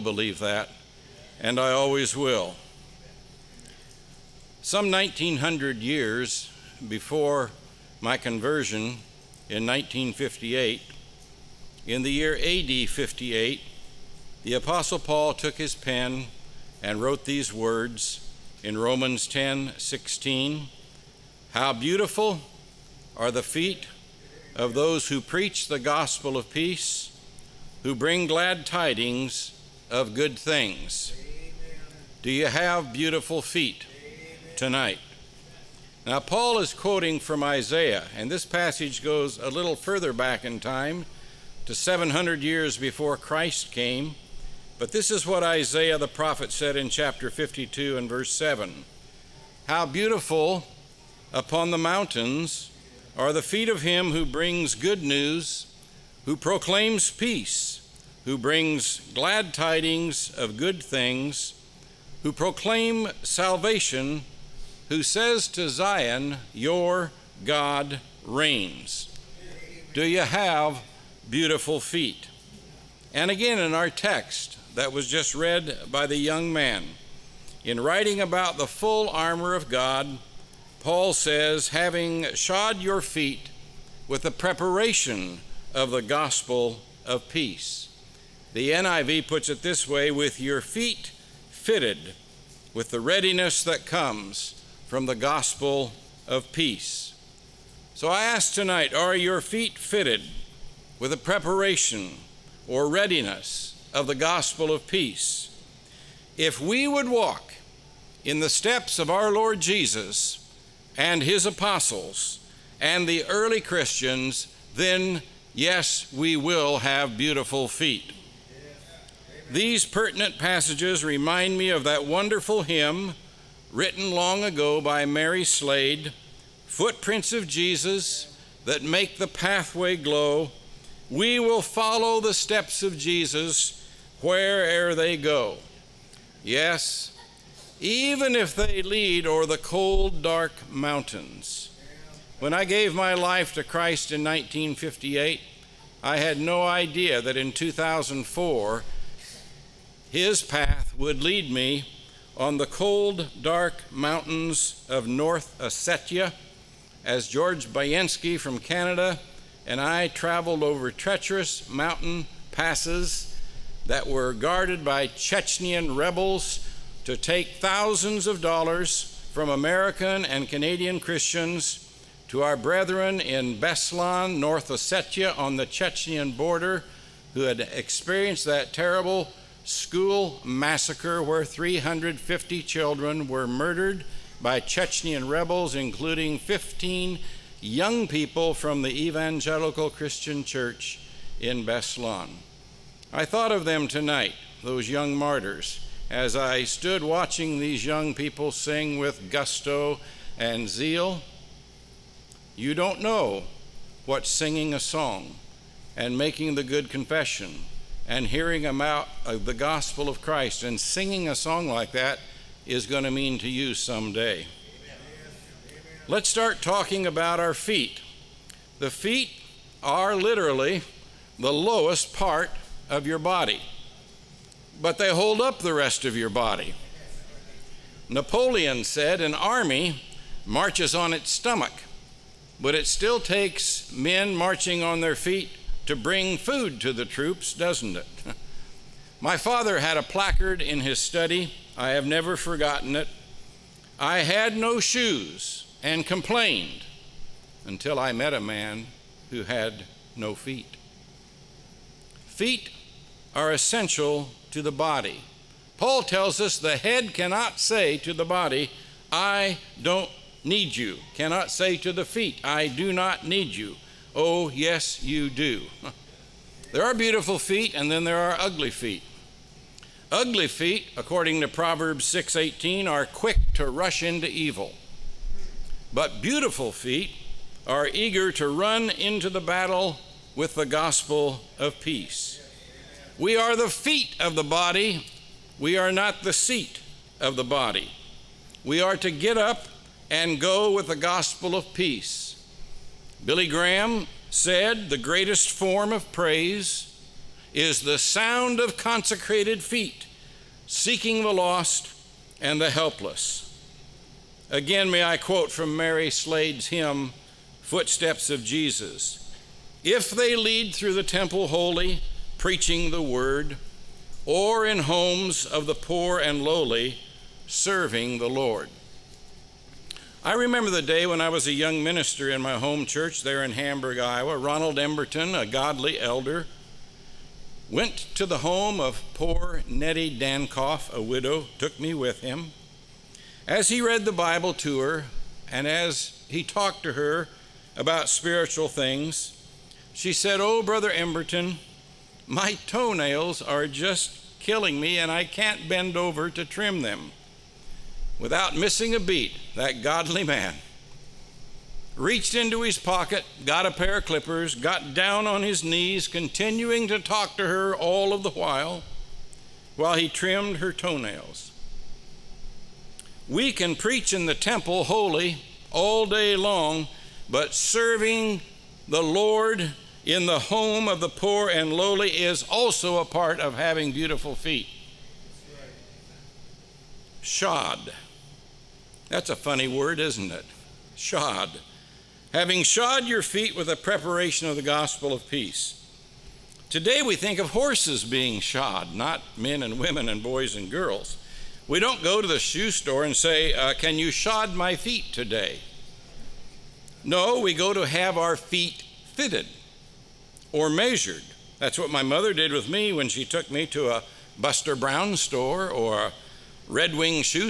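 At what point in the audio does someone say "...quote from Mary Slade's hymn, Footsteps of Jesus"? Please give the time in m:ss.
5:05.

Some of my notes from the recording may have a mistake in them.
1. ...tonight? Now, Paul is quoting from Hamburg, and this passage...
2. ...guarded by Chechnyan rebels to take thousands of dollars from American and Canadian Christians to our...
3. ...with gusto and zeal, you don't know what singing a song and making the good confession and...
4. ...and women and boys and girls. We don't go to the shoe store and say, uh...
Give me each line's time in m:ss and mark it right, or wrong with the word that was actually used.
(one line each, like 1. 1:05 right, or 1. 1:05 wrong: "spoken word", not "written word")
1. 0:34 wrong: "Isaiah", not "Hamburg"
2. 2:44 right
3. 3:18 right
4. 6:29 right.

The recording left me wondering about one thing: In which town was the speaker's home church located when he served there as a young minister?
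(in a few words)
Hamburg, Iowa.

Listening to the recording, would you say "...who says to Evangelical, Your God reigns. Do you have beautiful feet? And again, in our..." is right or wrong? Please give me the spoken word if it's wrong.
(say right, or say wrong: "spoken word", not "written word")
wrong: "Zion", not "Evangelical".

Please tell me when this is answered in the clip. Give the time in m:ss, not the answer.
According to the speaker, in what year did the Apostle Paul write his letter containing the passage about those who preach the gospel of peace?
0:12.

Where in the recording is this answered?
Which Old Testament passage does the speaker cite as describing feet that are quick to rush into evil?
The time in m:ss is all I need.
4:31.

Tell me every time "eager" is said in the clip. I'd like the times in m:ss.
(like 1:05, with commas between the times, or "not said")
4:37.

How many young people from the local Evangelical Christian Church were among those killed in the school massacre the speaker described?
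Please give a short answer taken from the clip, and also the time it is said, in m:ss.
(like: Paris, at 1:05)
15, at 3:06.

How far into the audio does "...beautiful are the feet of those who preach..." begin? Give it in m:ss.
0:21.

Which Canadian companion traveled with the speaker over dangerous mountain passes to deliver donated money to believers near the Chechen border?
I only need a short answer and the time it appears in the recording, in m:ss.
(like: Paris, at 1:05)
George Bayensky, at 2:37.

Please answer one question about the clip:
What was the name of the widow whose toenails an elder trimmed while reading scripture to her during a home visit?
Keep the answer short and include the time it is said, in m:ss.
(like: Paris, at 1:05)
Nettie Dankoff, at 5:29.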